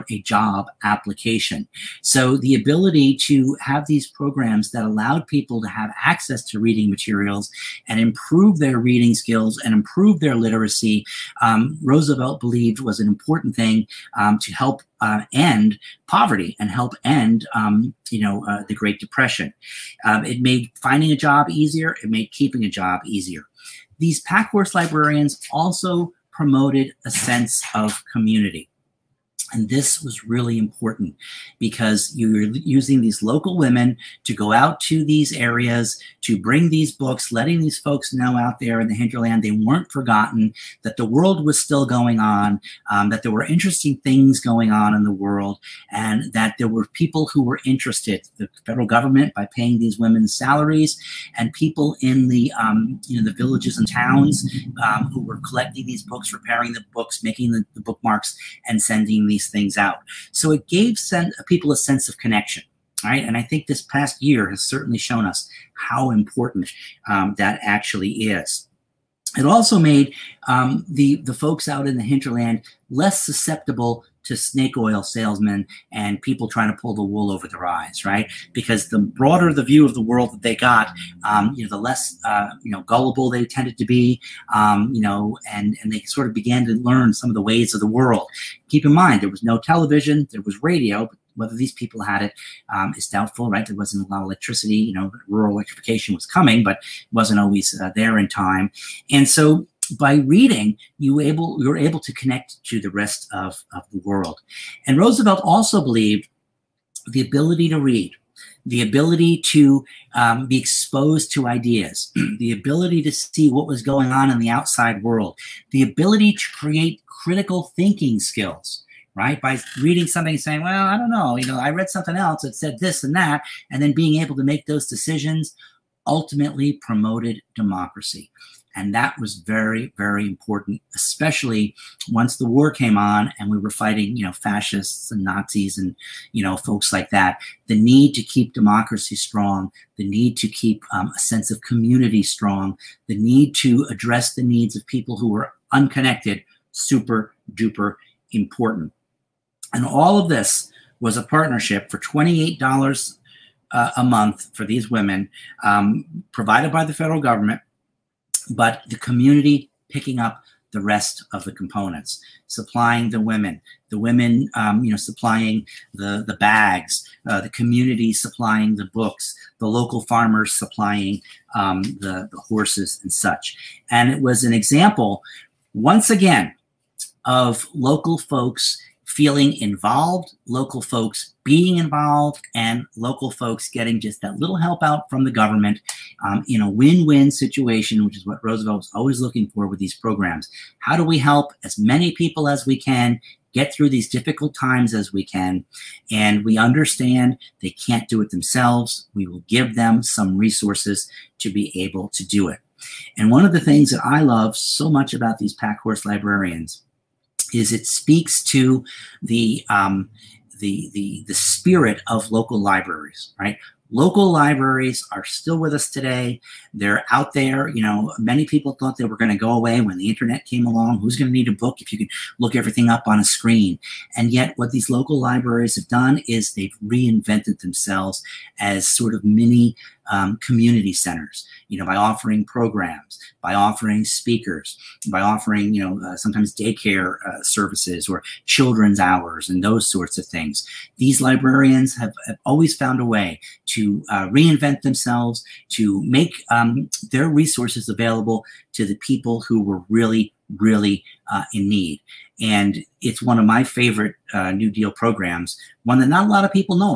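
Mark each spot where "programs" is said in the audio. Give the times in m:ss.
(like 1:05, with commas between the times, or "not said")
0:04, 3:09, 3:52, 4:14.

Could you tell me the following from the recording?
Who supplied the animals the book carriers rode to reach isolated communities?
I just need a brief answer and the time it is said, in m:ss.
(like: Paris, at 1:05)
local farmers, at 2:49.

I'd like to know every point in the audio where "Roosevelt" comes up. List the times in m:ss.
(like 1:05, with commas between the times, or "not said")
0:11, 1:44, 3:08.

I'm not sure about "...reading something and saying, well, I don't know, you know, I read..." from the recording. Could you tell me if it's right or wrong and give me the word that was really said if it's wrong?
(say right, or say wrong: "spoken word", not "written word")
right.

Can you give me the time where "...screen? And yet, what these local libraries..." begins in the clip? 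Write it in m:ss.
3:43.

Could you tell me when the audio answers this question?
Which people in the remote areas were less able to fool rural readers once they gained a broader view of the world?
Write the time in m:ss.
1:14.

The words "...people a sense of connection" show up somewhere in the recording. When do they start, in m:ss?
1:01.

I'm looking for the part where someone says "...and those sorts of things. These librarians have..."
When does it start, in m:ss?
3:59.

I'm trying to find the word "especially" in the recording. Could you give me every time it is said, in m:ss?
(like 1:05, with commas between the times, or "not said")
2:10.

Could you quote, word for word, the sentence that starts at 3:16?
And we understand they can't do it themselves.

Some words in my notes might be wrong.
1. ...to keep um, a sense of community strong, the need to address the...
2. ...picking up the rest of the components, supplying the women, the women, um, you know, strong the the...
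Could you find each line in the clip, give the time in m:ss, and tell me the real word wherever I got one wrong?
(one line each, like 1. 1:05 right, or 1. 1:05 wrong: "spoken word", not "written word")
1. 2:20 right
2. 2:39 wrong: "supplying", not "strong".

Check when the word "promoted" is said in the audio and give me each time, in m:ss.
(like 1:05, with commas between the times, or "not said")
0:26, 2:06.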